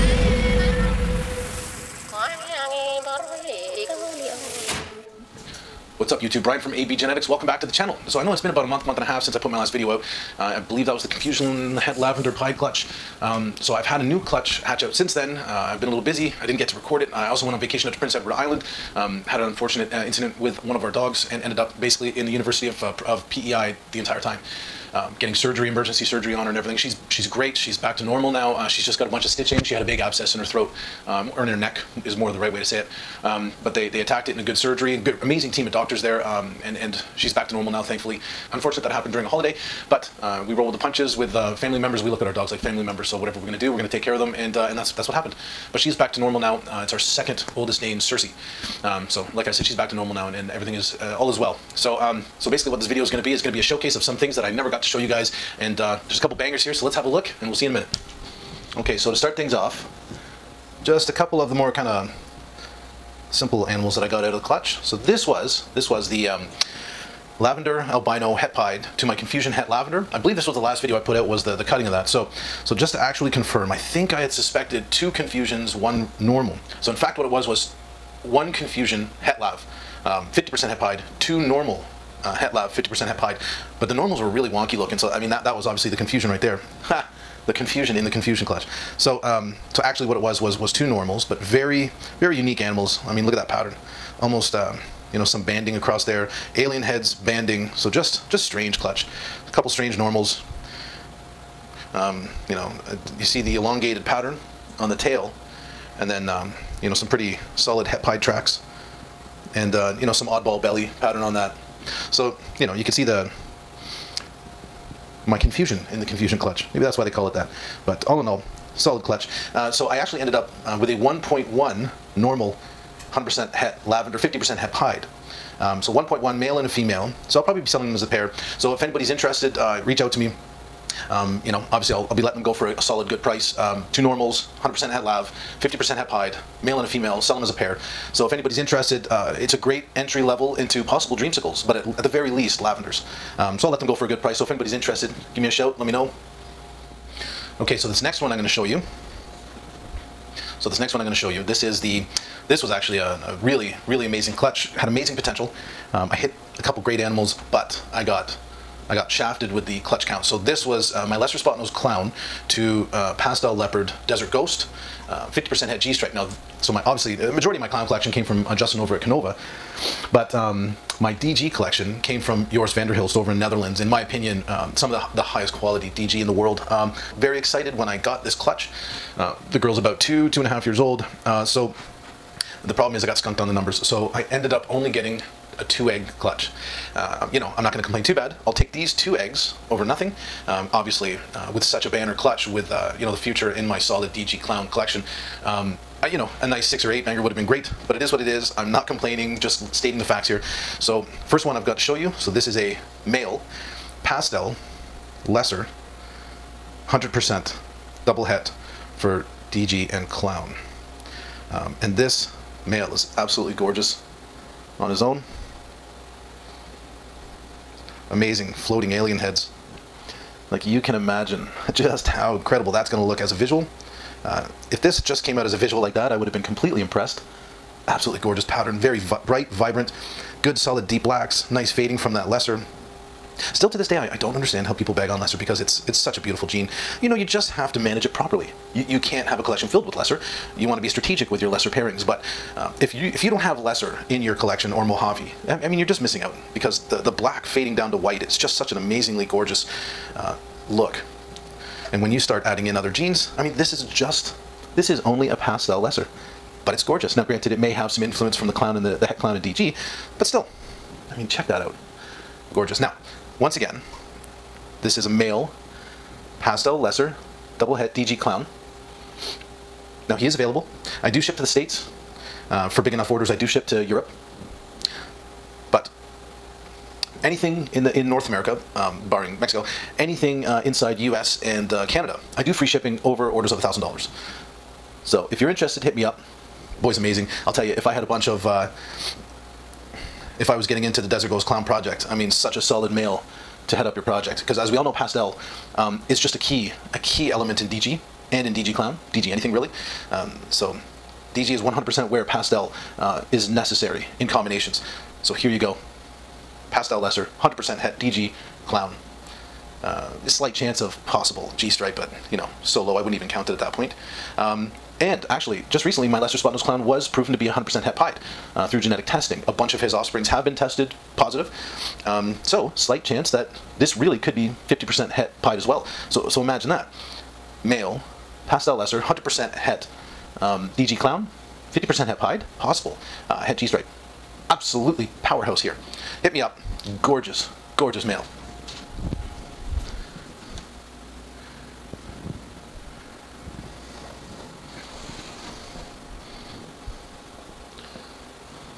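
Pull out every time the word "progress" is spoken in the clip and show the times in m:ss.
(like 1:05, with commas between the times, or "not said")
not said.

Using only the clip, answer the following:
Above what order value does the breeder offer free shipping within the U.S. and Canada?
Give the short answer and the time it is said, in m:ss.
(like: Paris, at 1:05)
$1000, at 4:43.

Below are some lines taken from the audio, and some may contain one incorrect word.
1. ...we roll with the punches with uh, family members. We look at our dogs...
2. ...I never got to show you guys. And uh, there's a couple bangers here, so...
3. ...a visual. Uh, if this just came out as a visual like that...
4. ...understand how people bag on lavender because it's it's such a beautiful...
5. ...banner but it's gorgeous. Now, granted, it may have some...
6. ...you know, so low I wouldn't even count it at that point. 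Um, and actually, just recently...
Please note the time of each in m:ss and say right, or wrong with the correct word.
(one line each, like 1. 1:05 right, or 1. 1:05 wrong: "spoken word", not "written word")
1. 0:40 right
2. 0:54 right
3. 3:43 right
4. 3:54 wrong: "lesser", not "lavender"
5. 4:15 wrong: "lesser", not "banner"
6. 5:12 right.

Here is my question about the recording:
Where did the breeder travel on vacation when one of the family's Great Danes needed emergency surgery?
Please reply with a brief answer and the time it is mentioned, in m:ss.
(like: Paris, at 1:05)
Prince Edward Island, at 0:17.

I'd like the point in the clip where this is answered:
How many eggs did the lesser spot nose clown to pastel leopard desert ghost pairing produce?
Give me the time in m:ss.
3:05.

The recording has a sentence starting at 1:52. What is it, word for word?
So you know you can see the my confusion in the confusion clutch.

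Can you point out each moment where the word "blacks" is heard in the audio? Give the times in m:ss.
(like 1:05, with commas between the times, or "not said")
3:51, 4:07.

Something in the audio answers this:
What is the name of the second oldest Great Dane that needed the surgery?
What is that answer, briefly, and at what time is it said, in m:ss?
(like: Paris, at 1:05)
Cersei, at 0:47.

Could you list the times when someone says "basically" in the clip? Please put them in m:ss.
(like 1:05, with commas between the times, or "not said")
0:21, 0:52.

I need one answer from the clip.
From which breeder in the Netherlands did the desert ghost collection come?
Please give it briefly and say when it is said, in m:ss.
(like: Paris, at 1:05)
Joris Vanderhilst, at 2:52.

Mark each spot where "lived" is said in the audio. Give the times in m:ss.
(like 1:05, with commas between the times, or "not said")
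not said.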